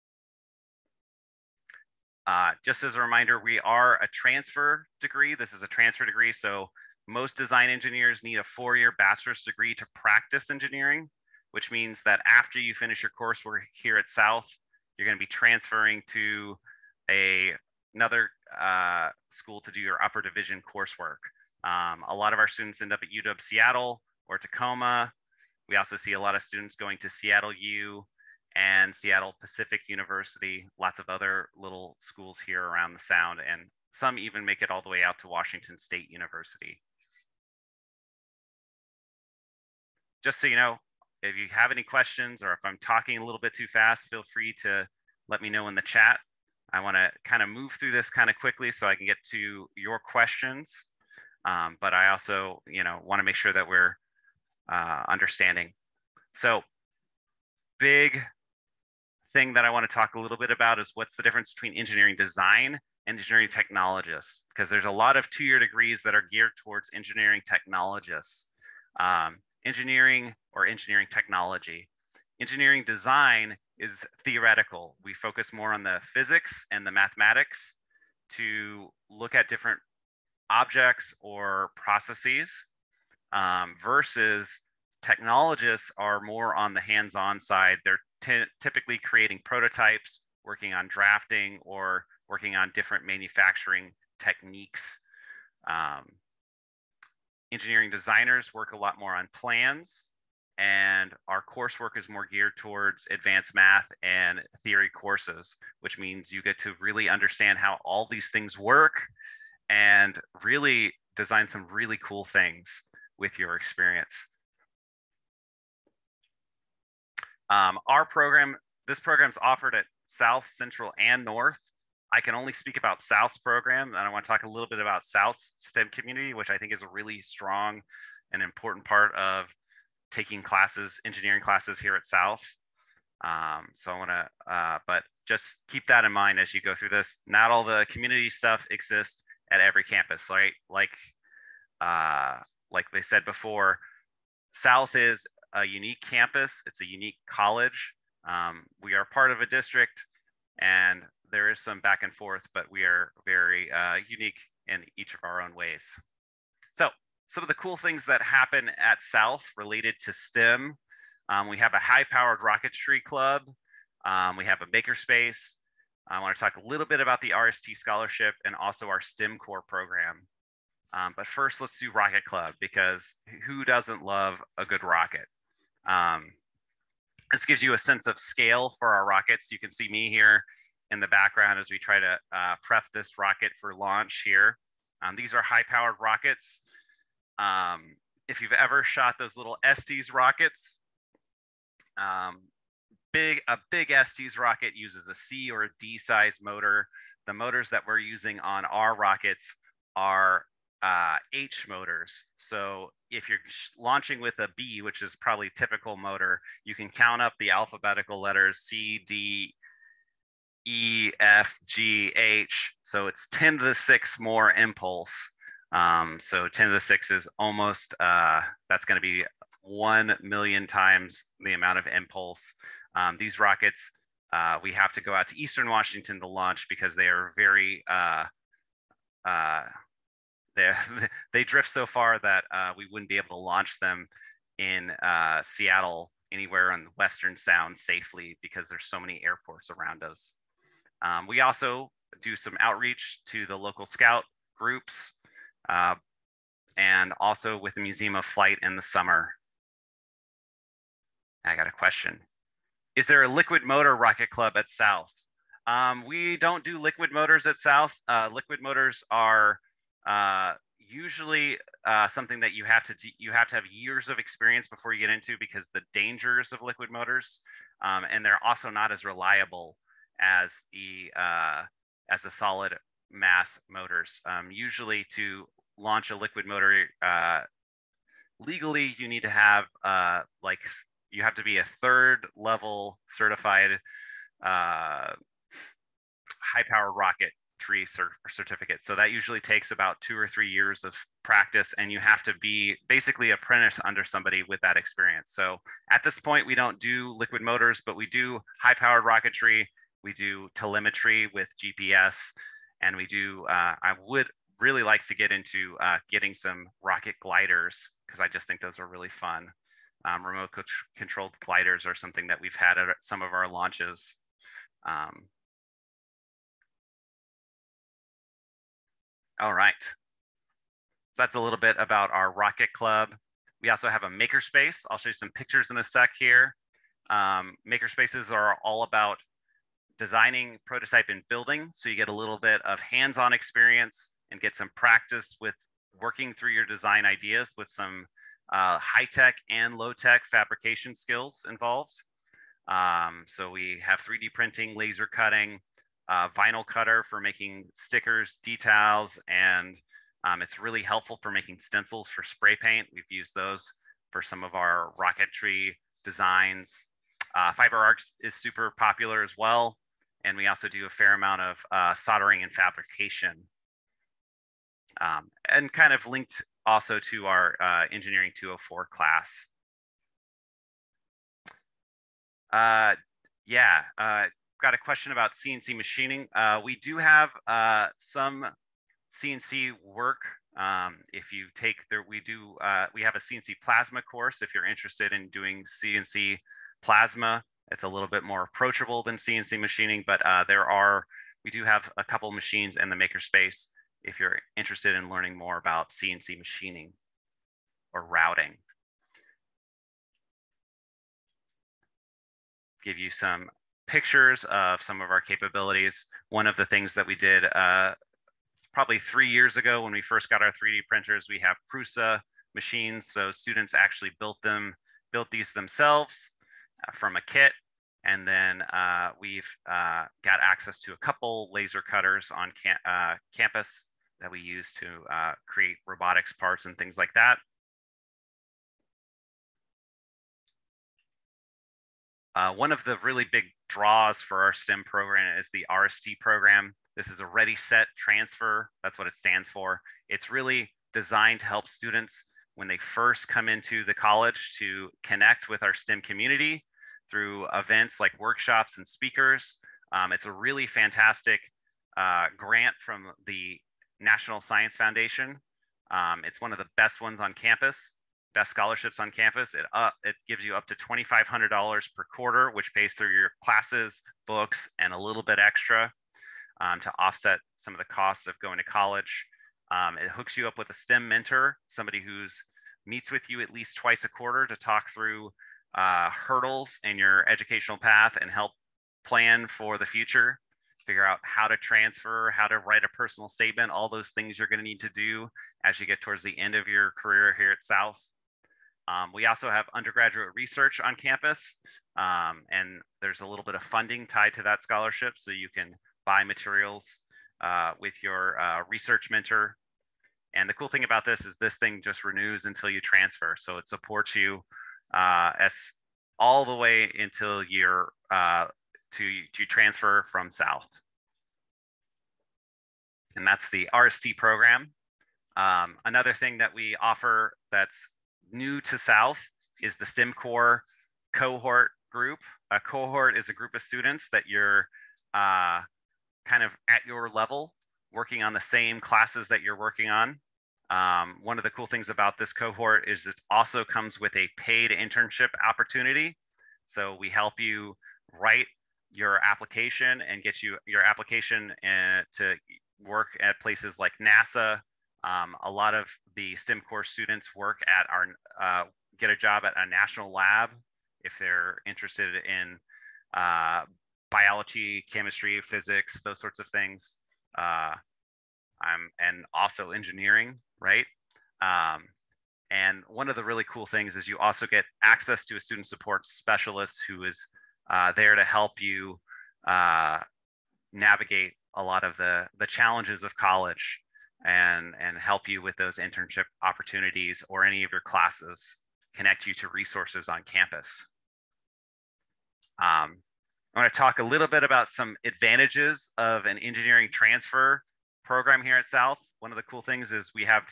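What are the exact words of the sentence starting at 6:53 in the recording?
So students actually built them, built these themselves uh, from a kit.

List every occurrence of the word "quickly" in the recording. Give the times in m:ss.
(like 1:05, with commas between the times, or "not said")
0:48.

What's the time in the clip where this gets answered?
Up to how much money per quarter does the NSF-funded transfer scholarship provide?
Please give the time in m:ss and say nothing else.
7:40.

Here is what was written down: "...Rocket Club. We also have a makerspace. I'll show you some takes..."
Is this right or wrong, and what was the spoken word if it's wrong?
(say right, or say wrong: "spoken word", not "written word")
wrong: "pictures", not "takes".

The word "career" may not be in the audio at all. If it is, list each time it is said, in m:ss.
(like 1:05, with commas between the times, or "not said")
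8:07.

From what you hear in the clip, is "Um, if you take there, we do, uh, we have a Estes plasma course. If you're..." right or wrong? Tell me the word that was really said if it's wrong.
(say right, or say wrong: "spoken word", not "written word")
wrong: "CNC", not "Estes".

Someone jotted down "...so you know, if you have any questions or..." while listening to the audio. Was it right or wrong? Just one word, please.
right.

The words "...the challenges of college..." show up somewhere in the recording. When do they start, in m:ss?
9:32.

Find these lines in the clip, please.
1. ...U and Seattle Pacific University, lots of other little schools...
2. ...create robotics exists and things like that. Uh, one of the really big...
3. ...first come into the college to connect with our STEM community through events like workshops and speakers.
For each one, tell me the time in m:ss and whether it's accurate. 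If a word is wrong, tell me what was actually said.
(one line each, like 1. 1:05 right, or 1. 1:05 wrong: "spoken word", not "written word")
1. 0:27 right
2. 7:05 wrong: "parts", not "exists"
3. 7:22 right.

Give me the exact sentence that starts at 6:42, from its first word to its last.
Give you some pictures of some of our capabilities.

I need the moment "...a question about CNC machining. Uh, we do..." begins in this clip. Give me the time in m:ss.
6:14.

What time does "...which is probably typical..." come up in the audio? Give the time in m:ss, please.
3:24.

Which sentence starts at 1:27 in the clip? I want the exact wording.
They're typically creating prototypes, working on drafting, or working on different manufacturing techniques.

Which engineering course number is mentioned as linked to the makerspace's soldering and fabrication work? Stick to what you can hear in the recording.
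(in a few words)
Engineering 204.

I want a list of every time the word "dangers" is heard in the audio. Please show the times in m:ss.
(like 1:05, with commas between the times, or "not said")
4:25.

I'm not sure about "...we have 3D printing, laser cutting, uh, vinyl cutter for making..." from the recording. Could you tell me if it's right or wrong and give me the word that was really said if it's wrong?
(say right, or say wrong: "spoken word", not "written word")
right.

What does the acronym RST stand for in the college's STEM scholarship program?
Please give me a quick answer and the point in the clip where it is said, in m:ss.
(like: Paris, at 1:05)
Ready, Set, Transfer, at 7:17.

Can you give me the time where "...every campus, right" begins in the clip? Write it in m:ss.
2:19.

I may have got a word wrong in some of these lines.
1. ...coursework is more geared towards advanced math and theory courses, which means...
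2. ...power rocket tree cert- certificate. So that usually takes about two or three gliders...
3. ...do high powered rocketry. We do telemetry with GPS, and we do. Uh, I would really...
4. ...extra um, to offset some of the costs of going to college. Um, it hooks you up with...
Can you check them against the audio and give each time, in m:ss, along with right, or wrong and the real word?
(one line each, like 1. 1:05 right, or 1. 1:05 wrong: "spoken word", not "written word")
1. 1:41 right
2. 4:46 wrong: "years", not "gliders"
3. 4:58 right
4. 7:45 right.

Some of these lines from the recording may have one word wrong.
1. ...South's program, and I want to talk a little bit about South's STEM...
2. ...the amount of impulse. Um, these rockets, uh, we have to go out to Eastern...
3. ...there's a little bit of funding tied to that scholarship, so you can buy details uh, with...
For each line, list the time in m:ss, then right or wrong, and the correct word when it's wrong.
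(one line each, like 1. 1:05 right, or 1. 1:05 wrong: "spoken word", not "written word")
1. 2:03 right
2. 3:41 right
3. 8:12 wrong: "materials", not "details".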